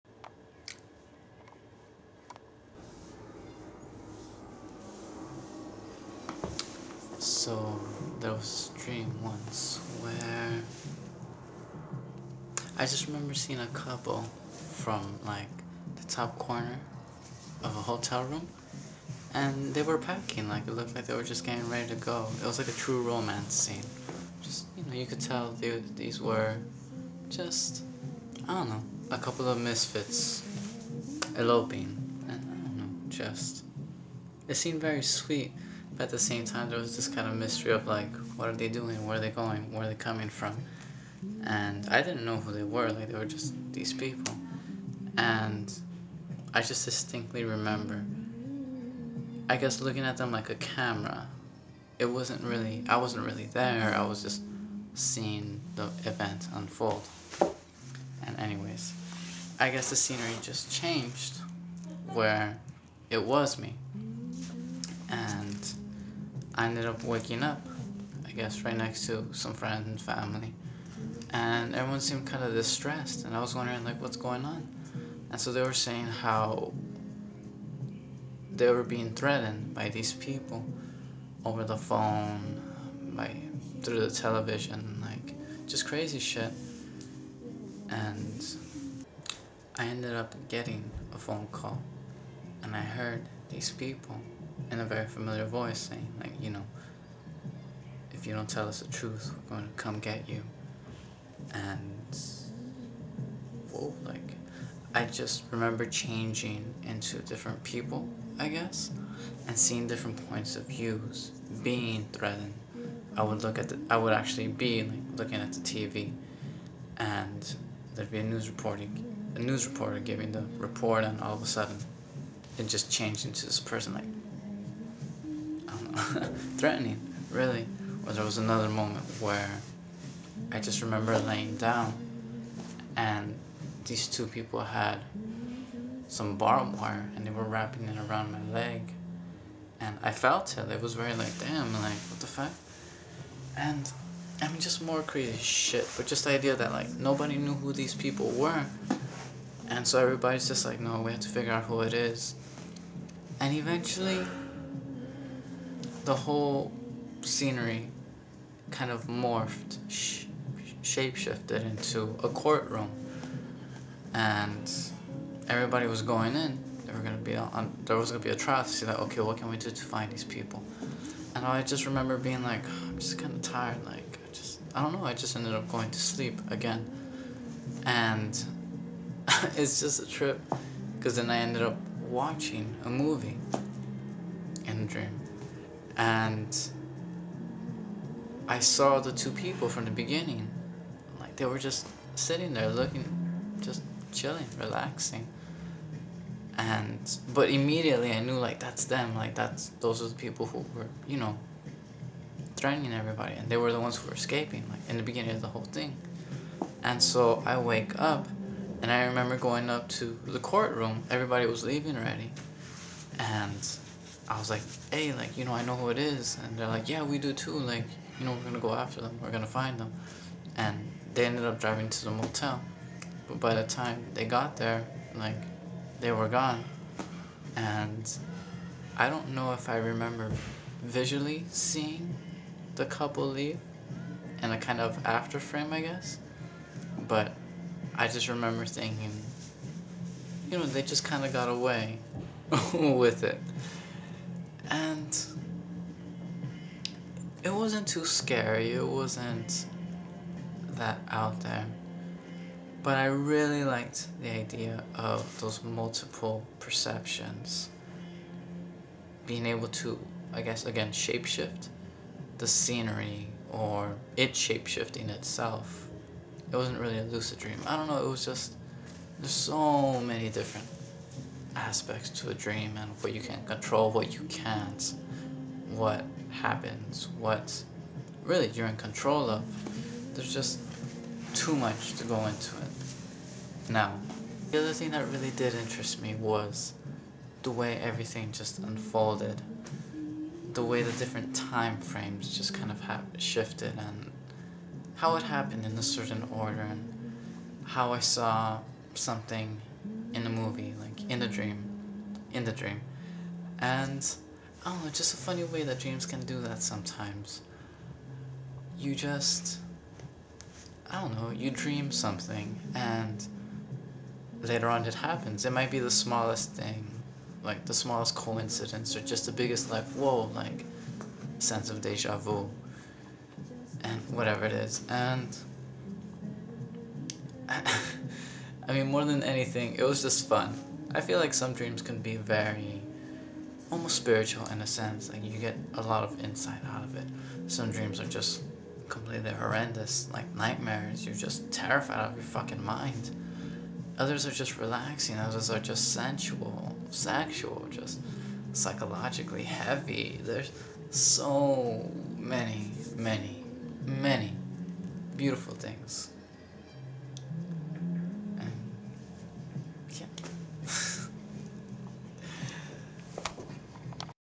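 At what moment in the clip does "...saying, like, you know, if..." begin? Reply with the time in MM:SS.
01:35.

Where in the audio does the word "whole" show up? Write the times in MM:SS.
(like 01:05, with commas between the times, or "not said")
02:36, 03:25.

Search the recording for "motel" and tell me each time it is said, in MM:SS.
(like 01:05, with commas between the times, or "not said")
03:42.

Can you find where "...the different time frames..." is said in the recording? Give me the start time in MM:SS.
04:50.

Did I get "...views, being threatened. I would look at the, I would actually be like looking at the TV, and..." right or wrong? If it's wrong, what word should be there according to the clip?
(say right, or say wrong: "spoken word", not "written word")
right.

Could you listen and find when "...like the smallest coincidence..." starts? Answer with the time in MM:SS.
05:17.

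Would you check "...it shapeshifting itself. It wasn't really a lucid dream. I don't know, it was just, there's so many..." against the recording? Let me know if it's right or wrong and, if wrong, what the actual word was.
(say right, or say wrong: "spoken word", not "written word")
right.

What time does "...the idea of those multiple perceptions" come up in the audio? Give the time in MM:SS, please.
04:14.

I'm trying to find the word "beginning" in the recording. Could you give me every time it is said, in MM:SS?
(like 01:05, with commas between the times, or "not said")
03:09, 03:25.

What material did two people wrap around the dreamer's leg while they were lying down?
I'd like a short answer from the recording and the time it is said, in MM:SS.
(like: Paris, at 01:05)
barbed wire, at 02:16.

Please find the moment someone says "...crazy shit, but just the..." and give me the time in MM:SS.
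02:25.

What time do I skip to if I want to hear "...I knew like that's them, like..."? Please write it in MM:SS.
03:18.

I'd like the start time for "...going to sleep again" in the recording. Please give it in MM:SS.
02:55.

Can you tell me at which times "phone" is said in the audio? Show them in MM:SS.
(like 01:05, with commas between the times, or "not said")
01:21, 01:31.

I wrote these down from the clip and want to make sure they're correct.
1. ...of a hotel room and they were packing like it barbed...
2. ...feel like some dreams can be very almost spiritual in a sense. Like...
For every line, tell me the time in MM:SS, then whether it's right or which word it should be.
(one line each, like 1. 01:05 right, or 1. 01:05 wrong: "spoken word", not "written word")
1. 00:17 wrong: "looked", not "barbed"
2. 05:31 right.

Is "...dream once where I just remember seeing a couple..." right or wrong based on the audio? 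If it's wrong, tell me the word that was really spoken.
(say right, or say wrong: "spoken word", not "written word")
right.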